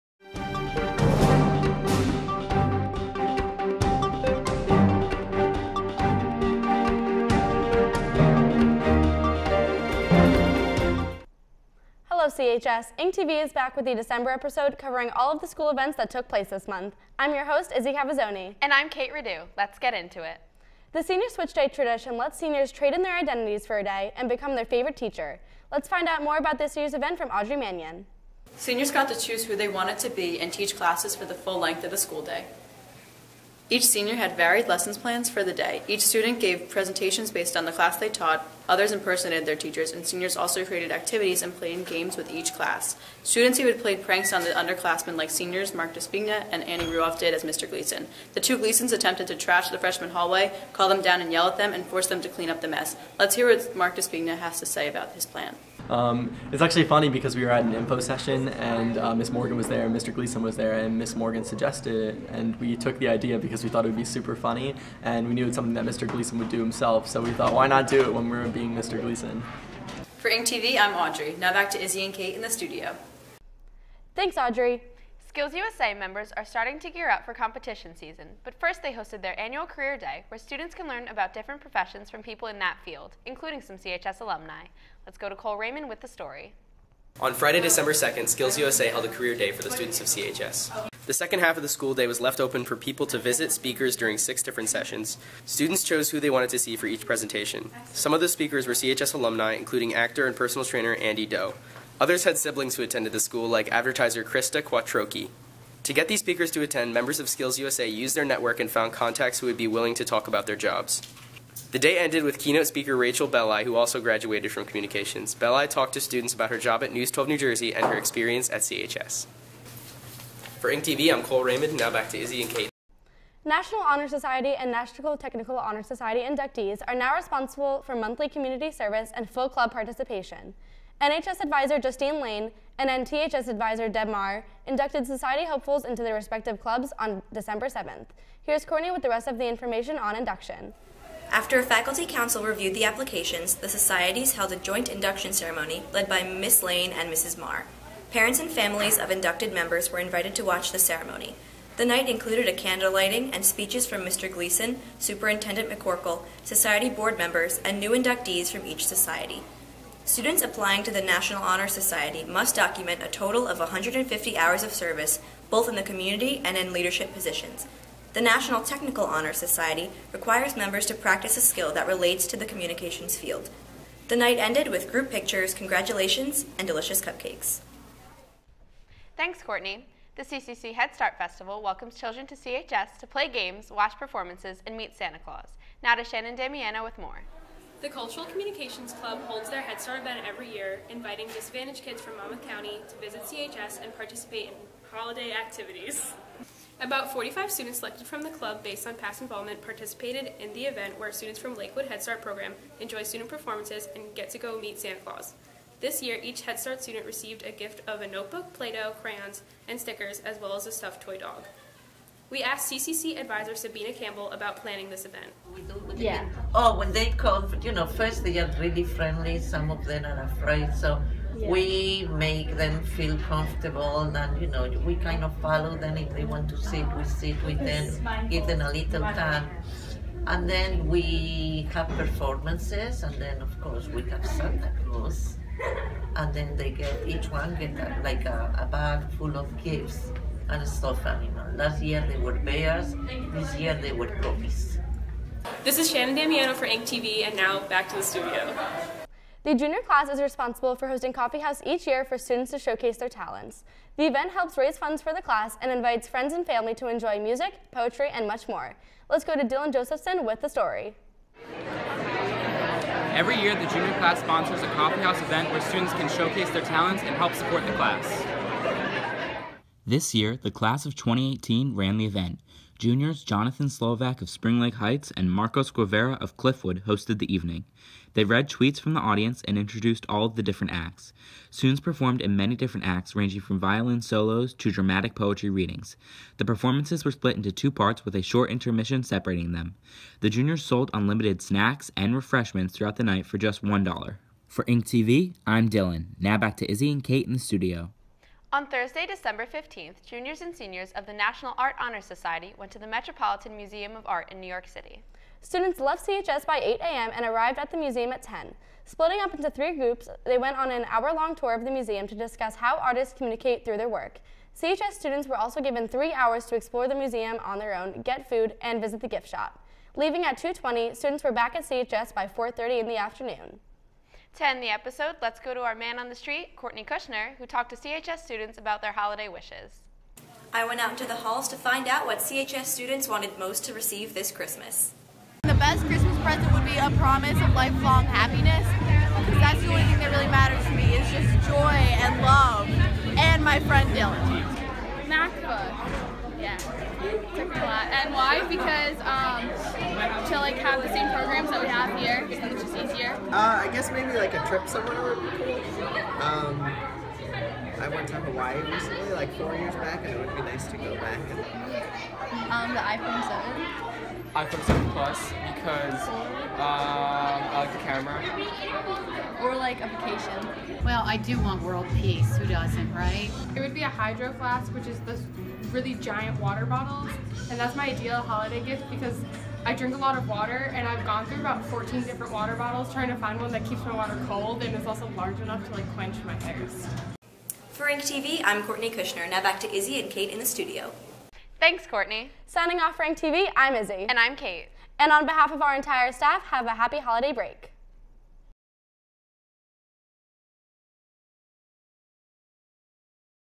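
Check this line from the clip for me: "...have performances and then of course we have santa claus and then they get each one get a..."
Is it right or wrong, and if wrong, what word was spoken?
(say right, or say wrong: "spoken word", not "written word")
right.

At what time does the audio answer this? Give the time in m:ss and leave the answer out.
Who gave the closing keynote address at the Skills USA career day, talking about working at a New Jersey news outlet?
1:52.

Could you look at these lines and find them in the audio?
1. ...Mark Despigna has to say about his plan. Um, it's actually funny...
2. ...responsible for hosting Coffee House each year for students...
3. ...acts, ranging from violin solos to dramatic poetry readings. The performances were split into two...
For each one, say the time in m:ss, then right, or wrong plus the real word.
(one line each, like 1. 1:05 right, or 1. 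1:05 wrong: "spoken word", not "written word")
1. 0:53 right
2. 4:10 right
3. 4:42 right.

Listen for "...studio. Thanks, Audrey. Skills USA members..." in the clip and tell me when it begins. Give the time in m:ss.
1:12.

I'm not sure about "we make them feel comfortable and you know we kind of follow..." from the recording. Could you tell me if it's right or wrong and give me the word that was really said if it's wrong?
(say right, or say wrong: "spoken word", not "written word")
right.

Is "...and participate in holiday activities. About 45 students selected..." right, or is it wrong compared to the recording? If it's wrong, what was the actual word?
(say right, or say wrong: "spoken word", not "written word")
right.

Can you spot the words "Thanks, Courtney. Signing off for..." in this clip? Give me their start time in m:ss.
6:31.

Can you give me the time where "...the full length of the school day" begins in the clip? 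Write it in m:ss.
0:31.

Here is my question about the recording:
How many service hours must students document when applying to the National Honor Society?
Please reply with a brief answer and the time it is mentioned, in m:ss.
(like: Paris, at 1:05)
150, at 2:43.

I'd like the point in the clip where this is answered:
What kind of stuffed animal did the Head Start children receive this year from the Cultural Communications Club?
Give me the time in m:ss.
3:30.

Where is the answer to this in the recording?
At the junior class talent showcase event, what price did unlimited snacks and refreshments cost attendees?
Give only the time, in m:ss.
4:53.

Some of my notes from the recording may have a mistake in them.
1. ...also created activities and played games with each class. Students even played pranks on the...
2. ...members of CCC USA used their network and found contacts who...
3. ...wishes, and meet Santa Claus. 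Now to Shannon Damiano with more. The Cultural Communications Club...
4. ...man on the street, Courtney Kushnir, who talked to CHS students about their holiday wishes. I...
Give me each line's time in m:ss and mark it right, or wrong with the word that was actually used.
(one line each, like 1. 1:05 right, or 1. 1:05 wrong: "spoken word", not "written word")
1. 0:40 right
2. 1:46 wrong: "Skills", not "CCC"
3. 3:03 wrong: "performances", not "wishes"
4. 5:25 right.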